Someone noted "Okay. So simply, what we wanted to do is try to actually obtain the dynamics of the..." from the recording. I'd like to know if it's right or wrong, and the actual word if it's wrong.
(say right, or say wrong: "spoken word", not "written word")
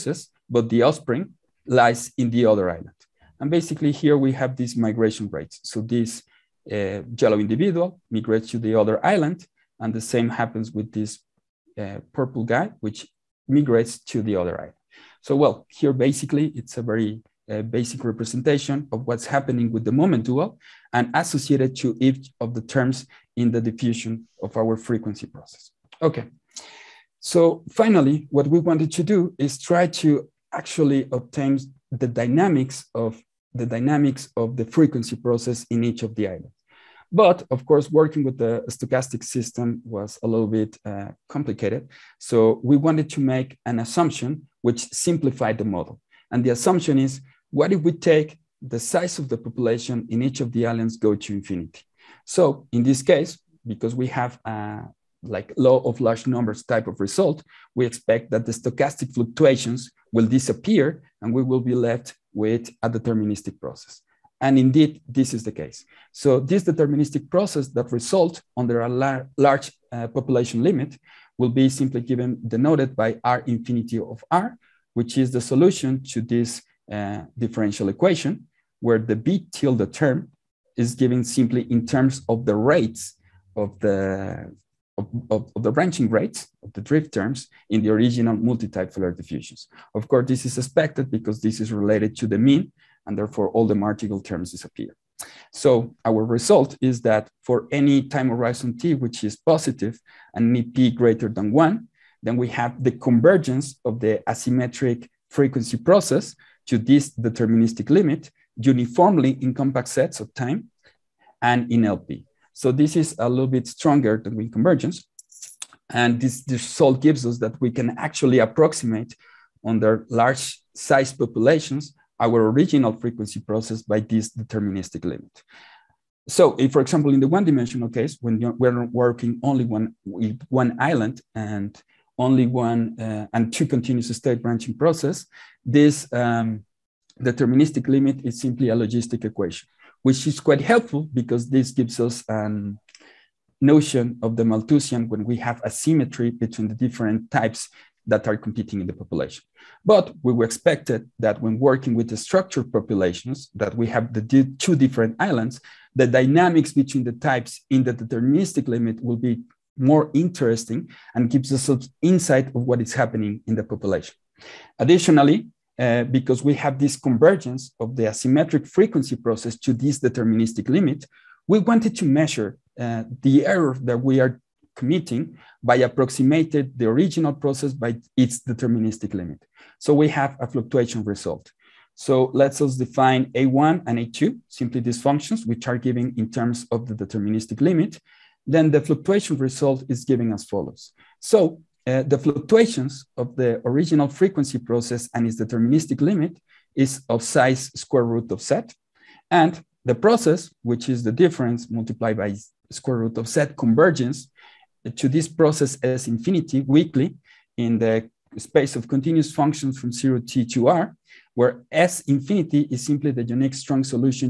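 wrong: "finally", not "simply".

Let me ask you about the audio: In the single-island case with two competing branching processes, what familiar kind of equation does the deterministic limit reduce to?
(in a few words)
logistic equation.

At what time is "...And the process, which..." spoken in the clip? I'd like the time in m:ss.
3:19.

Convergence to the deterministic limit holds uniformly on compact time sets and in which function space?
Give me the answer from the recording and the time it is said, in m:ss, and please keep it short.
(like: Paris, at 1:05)
LP, at 1:51.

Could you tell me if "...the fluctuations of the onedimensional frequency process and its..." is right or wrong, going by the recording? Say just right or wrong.
wrong.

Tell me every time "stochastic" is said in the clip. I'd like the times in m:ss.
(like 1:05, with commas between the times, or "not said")
0:38, 0:58.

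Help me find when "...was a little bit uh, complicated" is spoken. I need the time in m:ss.
0:39.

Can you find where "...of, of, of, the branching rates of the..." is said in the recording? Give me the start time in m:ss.
1:24.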